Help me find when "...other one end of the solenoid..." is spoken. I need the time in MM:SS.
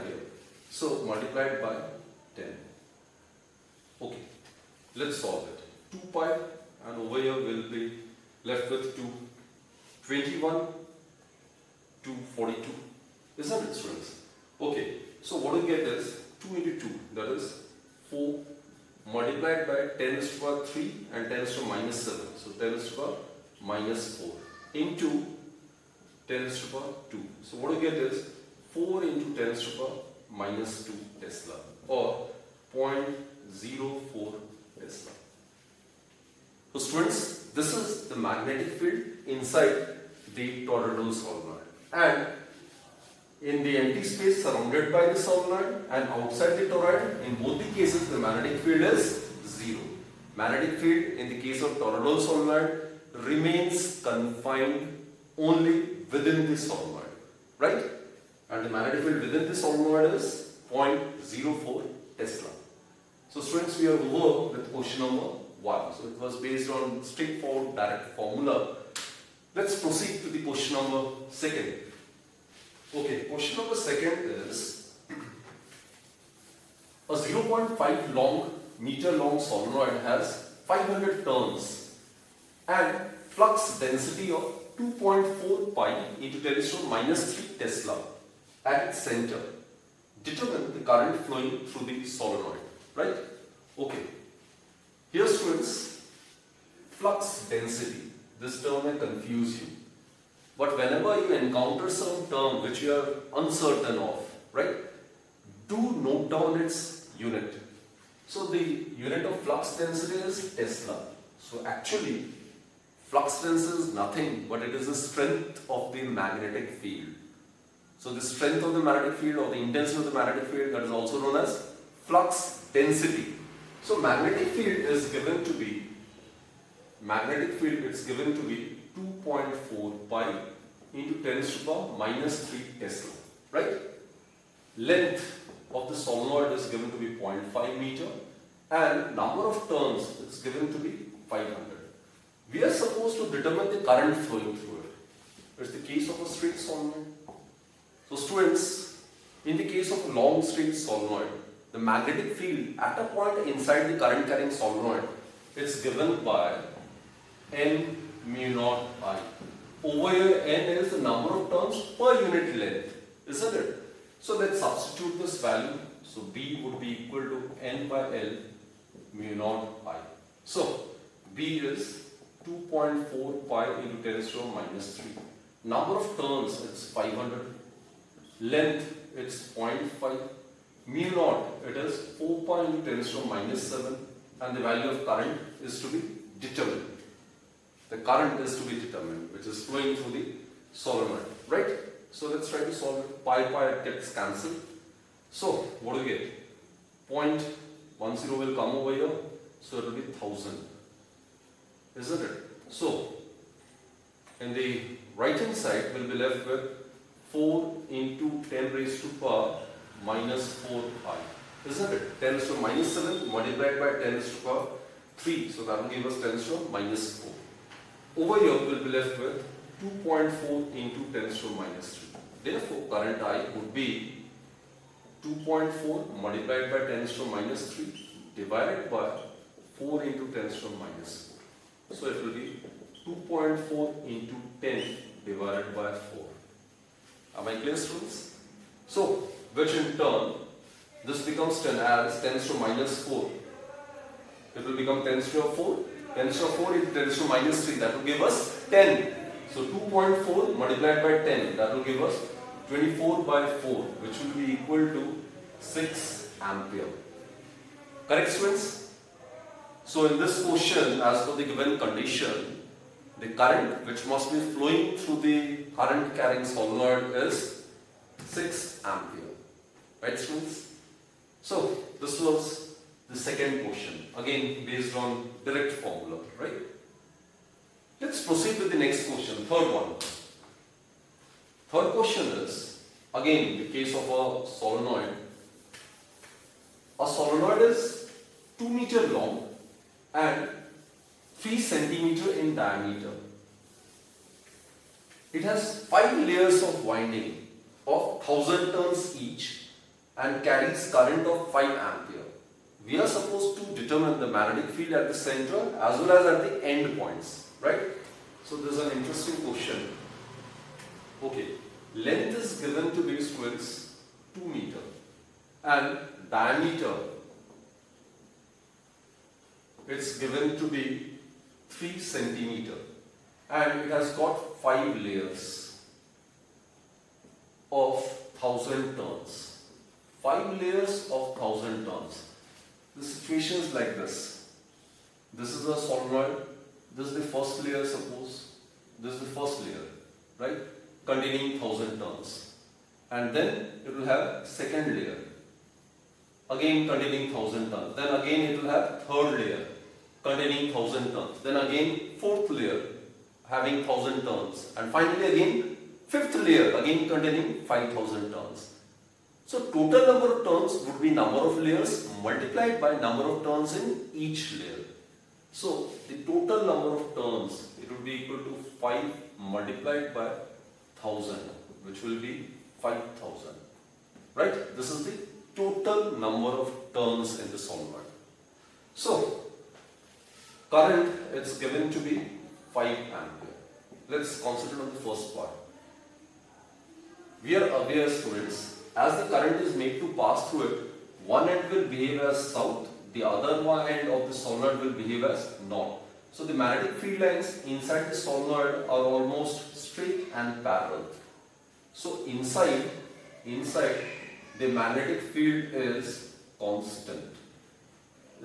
06:33.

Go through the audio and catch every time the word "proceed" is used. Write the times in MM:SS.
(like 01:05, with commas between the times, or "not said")
01:09, 04:38.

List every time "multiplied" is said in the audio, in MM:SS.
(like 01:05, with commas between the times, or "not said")
00:01, 00:19, 03:33, 03:46, 04:10, 06:02, 06:09.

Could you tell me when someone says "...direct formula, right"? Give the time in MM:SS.
04:35.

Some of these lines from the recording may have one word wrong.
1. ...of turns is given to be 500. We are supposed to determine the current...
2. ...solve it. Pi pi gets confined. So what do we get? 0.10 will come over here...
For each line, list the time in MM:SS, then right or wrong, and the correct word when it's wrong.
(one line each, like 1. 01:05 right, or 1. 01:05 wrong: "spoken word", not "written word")
1. 02:19 right
2. 03:12 wrong: "cancelled", not "confined".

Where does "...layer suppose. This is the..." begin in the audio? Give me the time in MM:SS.
05:37.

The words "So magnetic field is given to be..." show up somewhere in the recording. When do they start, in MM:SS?
02:03.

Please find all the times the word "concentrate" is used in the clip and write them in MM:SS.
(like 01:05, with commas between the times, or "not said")
06:24.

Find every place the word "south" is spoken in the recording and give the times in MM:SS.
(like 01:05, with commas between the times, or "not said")
06:32.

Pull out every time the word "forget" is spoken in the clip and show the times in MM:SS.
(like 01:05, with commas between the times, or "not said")
not said.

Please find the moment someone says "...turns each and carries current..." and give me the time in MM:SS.
04:58.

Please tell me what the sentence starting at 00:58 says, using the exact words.
And the magnetic field within the solenoid is 0.04 Tesla.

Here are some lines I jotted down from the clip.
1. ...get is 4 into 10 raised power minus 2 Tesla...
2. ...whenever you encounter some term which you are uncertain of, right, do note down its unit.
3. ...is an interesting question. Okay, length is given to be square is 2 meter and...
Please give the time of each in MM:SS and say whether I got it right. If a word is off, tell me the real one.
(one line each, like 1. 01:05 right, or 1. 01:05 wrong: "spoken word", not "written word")
1. 00:27 right
2. 01:40 right
3. 05:08 right.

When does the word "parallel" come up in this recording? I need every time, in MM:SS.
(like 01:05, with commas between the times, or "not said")
06:40.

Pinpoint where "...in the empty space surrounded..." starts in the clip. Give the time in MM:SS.
00:43.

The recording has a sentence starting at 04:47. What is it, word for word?
A solenoid is 2 meter long and 3 centimeter in diameter.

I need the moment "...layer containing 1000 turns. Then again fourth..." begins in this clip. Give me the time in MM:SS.
05:49.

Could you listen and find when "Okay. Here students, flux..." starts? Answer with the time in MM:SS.
01:33.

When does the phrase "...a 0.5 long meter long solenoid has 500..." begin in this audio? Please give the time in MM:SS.
01:17.